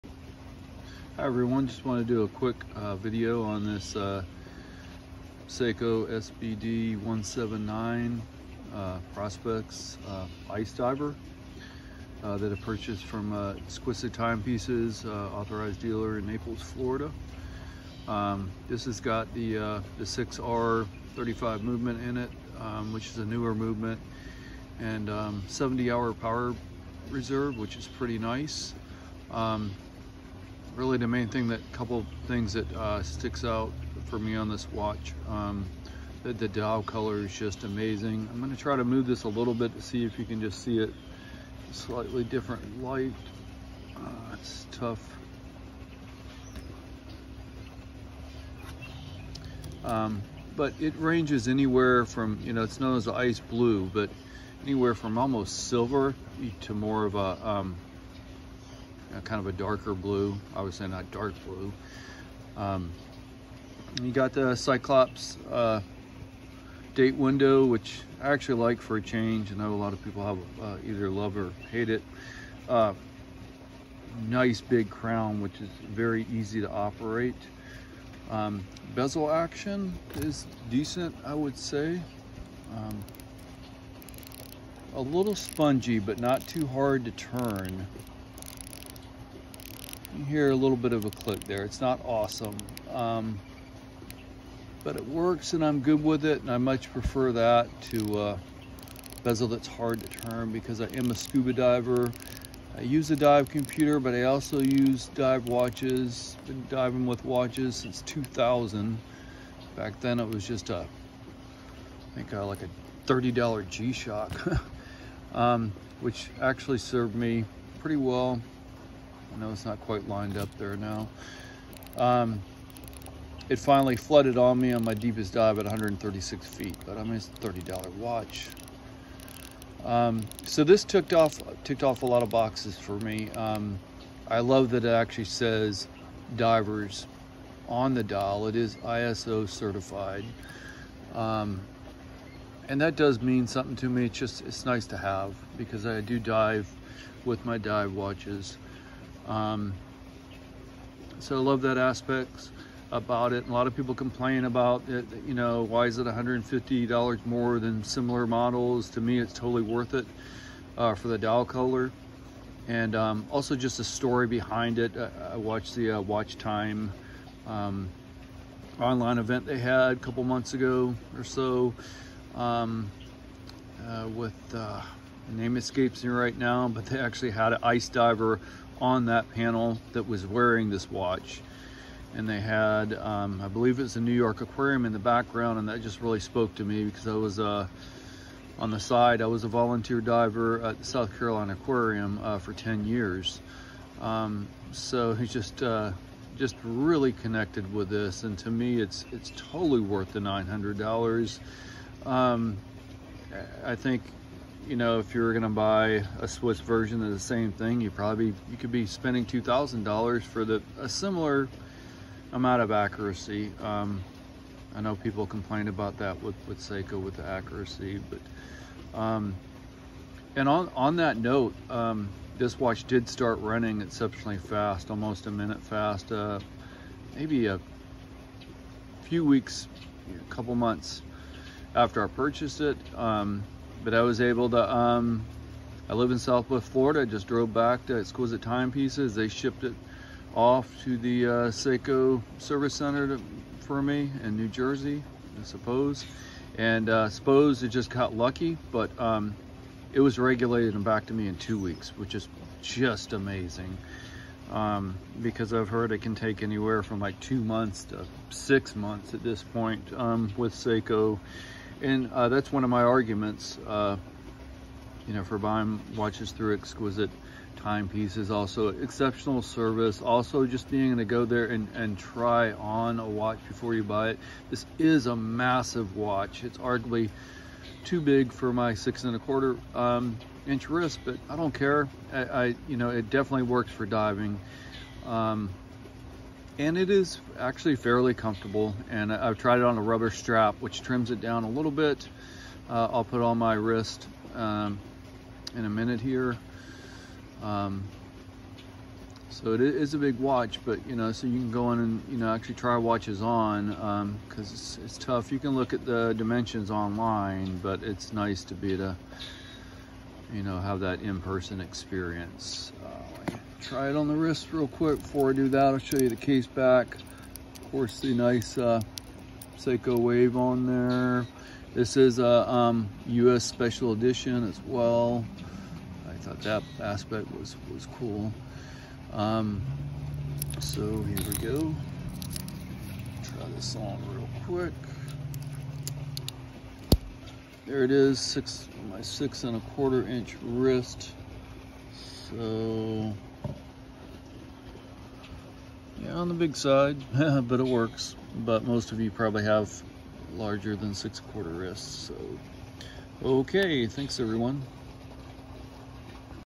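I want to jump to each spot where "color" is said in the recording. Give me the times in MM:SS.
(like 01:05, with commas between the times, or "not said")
00:36, 02:41.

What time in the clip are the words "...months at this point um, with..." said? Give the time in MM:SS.
04:18.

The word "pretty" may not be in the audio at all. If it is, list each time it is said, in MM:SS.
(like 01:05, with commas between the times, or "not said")
00:27, 01:57.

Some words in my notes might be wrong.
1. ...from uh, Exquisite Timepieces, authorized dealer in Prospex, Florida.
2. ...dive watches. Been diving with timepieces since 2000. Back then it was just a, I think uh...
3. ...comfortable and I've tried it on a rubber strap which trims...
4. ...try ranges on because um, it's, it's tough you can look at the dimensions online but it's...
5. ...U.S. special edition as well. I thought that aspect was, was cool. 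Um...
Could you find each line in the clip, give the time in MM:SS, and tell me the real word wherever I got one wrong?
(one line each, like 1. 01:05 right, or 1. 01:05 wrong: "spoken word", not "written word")
1. 00:13 wrong: "Naples", not "Prospex"
2. 01:45 wrong: "watches", not "timepieces"
3. 04:48 right
4. 05:02 wrong: "watches", not "ranges"
5. 05:23 right.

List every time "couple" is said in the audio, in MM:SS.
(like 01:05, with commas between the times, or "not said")
00:31, 02:49, 03:50.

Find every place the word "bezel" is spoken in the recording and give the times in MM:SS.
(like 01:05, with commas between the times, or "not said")
01:18, 01:39.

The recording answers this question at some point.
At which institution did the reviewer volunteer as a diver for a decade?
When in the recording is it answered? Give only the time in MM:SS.
03:10.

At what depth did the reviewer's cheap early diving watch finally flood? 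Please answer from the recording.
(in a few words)
136 feet.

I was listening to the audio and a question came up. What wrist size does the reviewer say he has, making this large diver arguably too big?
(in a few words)
6.25 inches.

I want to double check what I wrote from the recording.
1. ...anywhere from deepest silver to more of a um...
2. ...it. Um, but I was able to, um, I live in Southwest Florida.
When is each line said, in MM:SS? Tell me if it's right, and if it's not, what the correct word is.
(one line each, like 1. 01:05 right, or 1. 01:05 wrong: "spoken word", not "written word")
1. 00:54 wrong: "almost", not "deepest"
2. 03:52 right.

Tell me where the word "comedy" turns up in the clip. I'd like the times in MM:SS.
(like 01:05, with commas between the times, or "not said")
not said.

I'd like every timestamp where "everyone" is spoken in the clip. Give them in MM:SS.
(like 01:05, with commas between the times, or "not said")
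00:01, 05:54.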